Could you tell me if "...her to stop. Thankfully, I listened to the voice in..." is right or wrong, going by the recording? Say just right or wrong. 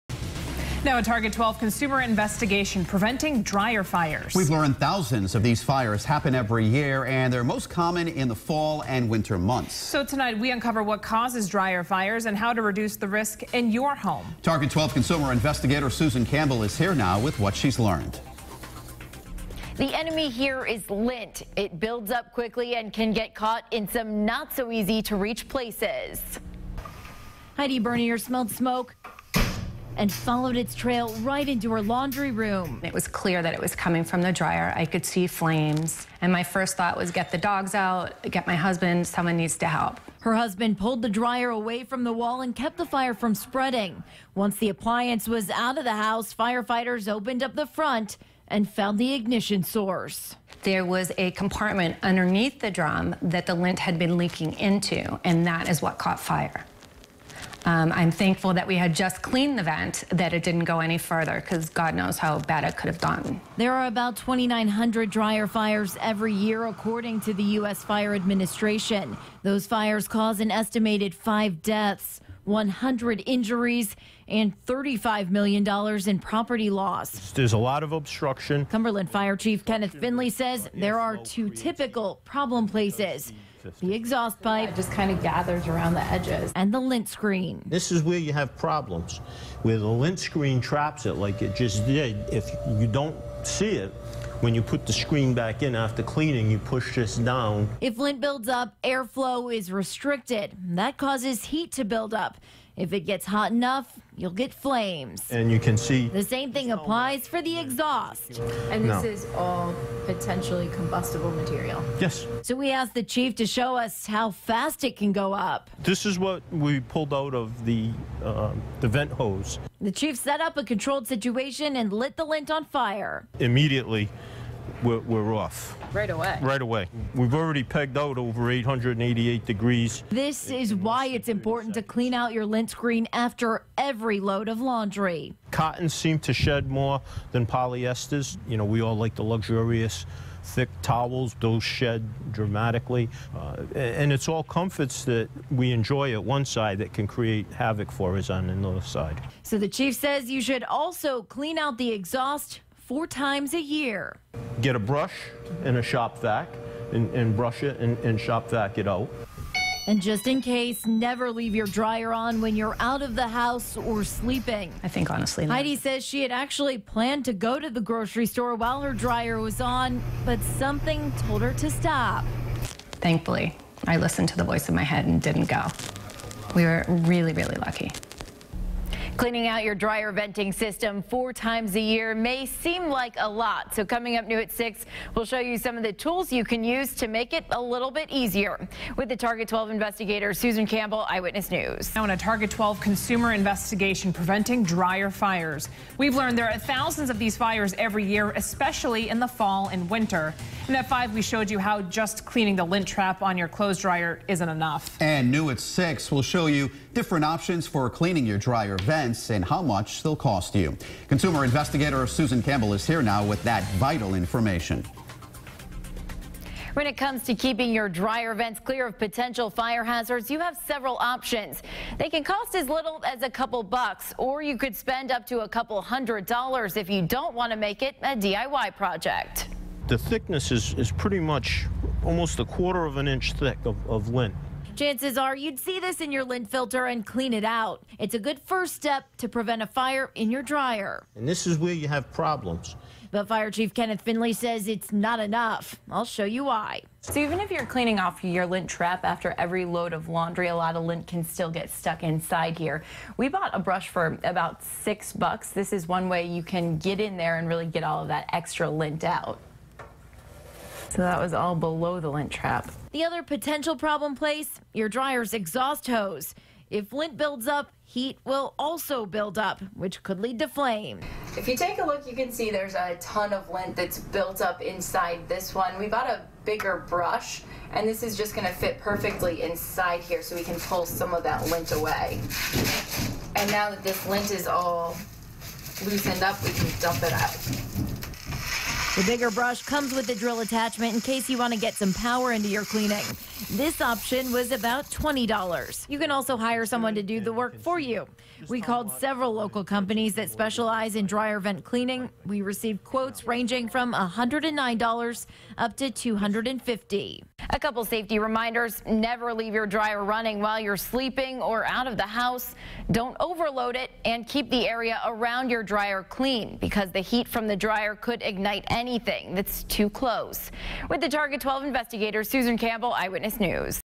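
right.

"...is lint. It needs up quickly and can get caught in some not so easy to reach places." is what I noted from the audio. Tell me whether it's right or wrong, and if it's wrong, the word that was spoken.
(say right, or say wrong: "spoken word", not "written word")
wrong: "builds", not "needs".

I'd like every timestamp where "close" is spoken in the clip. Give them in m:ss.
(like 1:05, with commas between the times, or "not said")
5:19.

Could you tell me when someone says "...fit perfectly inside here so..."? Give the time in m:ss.
4:38.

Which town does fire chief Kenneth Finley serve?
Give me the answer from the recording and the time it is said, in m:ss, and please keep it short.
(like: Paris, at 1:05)
Cumberland, at 1:18.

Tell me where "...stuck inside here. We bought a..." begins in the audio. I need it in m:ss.
4:11.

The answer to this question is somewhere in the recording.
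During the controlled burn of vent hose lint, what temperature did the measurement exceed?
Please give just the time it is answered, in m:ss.
2:08.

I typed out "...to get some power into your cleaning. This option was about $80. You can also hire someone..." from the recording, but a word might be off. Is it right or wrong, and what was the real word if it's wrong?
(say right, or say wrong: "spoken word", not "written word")
wrong: "20", not "80".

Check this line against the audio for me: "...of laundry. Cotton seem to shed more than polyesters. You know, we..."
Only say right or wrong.
right.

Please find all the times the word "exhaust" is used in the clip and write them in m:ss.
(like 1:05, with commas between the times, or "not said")
1:23, 1:47, 2:31, 4:25.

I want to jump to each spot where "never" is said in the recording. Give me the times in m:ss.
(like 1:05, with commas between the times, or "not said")
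2:40, 5:08.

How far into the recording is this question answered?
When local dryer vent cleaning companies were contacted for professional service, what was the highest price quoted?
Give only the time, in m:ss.
5:05.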